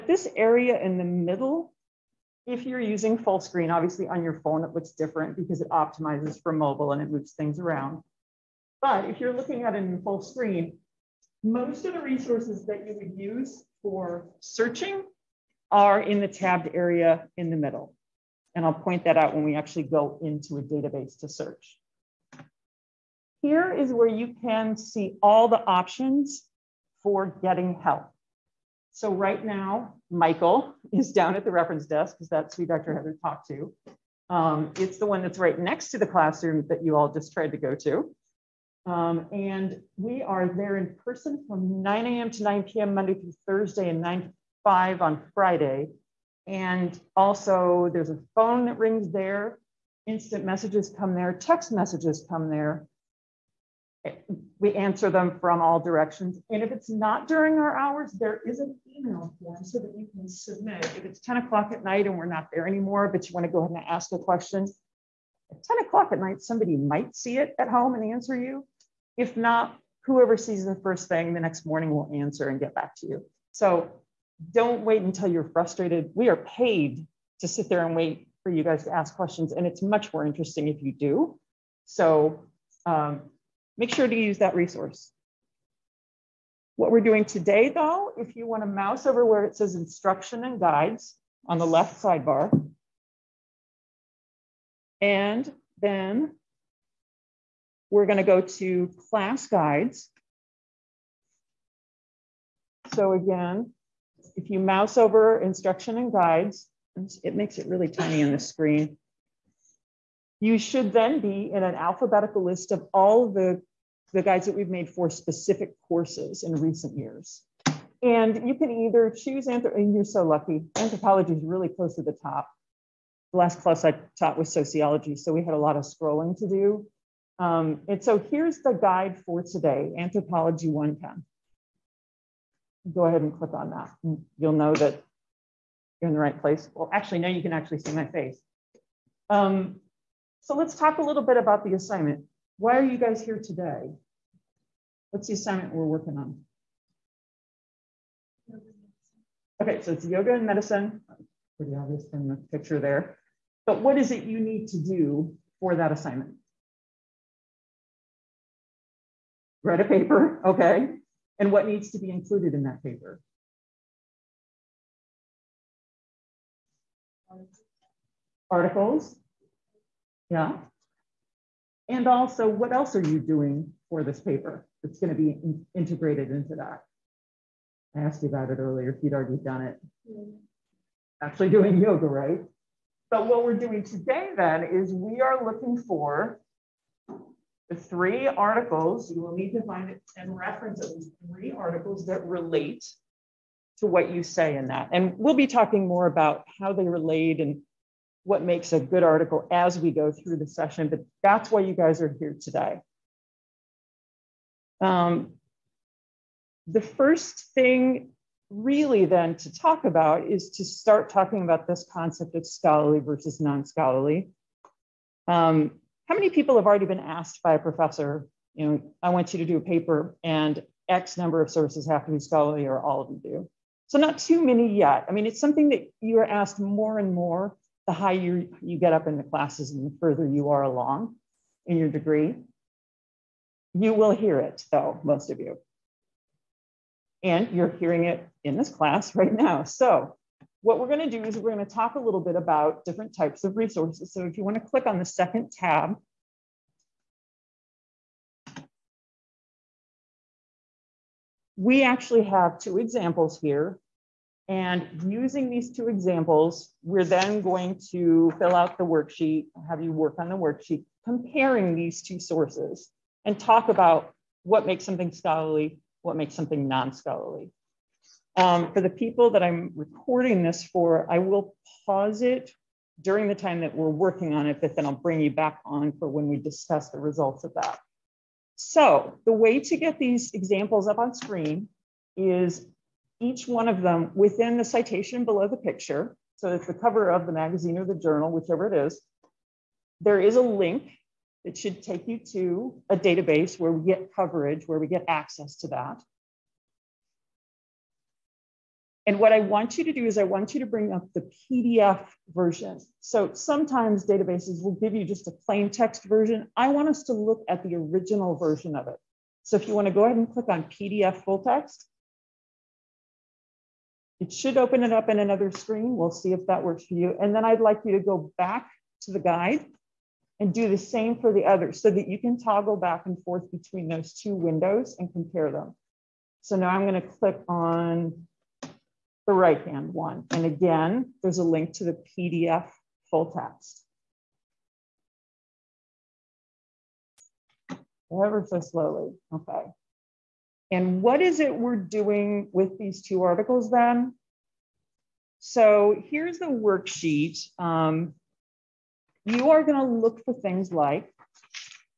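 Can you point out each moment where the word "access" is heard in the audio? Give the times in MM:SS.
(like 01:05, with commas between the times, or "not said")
04:55.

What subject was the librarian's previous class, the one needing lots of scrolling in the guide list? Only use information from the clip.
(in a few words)
Sociology.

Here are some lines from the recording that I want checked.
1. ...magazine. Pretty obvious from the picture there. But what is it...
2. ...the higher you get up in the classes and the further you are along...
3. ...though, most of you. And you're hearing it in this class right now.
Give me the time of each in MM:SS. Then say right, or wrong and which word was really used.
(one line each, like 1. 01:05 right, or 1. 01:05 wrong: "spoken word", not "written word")
1. 02:30 wrong: "medicine", not "magazine"
2. 03:47 right
3. 03:54 right.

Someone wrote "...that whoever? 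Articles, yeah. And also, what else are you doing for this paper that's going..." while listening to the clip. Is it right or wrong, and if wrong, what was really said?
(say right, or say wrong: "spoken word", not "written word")
wrong: "paper", not "whoever".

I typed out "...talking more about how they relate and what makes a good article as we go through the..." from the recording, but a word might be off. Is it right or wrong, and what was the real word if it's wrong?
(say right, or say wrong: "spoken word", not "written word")
right.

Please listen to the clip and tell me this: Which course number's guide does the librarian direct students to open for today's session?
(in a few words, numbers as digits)
Anthropology 110.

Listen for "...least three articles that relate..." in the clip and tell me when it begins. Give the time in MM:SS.
03:10.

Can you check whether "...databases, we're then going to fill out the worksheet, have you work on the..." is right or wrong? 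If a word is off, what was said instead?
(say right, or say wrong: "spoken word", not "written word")
wrong: "examples", not "databases".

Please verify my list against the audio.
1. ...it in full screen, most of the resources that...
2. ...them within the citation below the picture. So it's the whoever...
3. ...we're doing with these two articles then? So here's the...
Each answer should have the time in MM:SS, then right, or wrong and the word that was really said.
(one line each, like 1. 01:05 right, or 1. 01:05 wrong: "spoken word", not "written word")
1. 00:09 right
2. 04:43 wrong: "cover", not "whoever"
3. 05:41 right.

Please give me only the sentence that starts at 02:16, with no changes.
Well, actually, now you can actually see my face.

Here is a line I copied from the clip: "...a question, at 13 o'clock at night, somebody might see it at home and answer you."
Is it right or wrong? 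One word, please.
wrong.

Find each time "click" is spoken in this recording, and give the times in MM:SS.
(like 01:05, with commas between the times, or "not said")
02:13, 04:04, 05:10, 05:27.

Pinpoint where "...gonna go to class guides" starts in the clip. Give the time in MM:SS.
01:38.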